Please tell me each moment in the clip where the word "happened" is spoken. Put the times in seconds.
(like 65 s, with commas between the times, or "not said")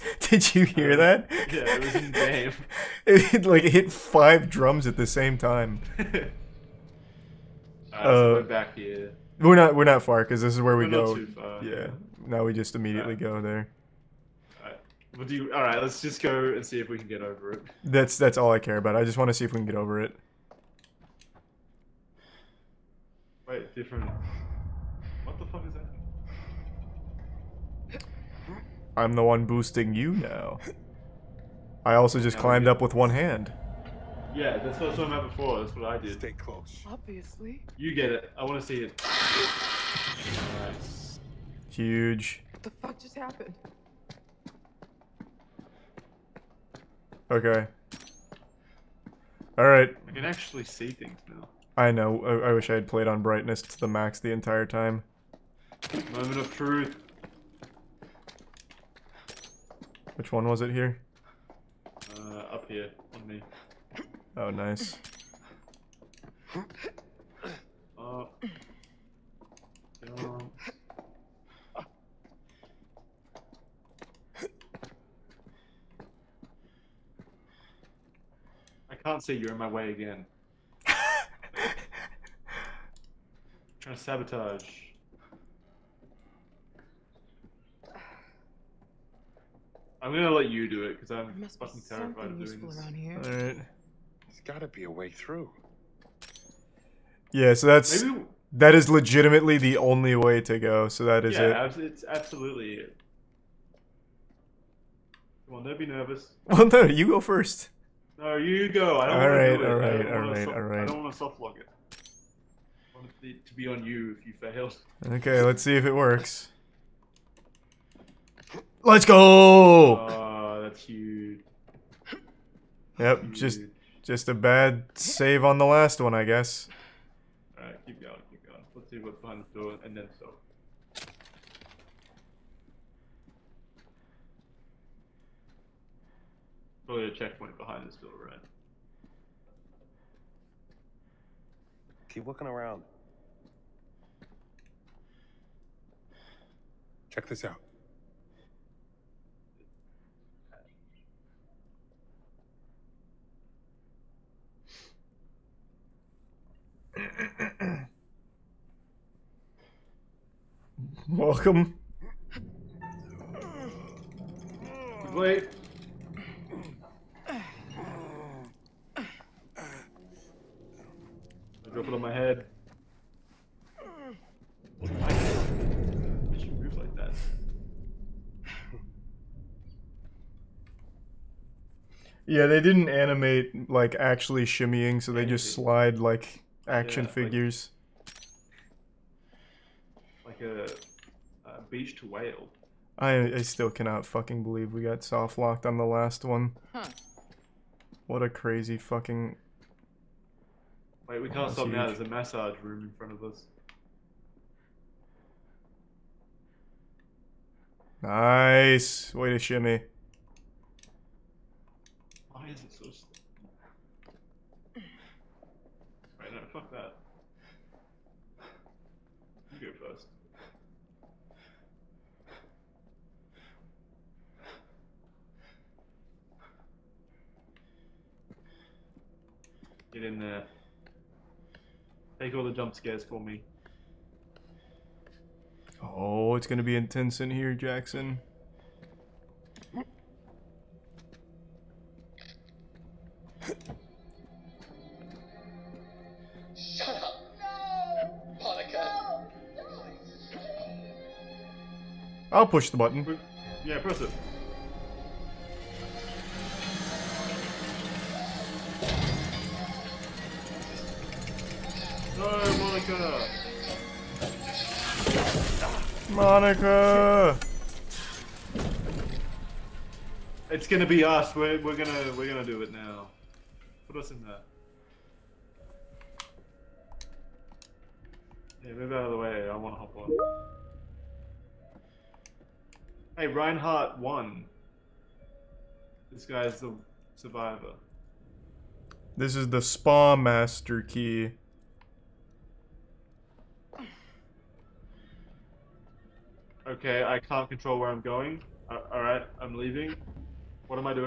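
43 s.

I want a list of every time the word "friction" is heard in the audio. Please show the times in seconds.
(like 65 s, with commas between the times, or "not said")
not said.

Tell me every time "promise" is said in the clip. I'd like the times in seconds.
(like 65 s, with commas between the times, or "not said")
not said.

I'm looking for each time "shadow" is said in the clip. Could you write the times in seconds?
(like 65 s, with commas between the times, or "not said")
not said.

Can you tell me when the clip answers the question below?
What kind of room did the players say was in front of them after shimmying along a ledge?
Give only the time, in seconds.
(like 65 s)
202 s.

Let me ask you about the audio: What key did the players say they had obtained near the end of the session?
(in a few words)
Spa Master key.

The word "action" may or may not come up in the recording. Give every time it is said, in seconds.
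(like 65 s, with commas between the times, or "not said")
186 s.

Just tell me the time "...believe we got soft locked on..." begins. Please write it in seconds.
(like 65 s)
194 s.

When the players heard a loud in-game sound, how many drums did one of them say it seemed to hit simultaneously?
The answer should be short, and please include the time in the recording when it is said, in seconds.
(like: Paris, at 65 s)
5, at 3 s.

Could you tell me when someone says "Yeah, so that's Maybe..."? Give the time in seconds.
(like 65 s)
97 s.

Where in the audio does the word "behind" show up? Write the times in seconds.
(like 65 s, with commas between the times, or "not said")
129 s, 137 s.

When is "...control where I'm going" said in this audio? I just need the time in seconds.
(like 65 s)
297 s.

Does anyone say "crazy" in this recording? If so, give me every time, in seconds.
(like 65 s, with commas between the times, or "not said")
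198 s.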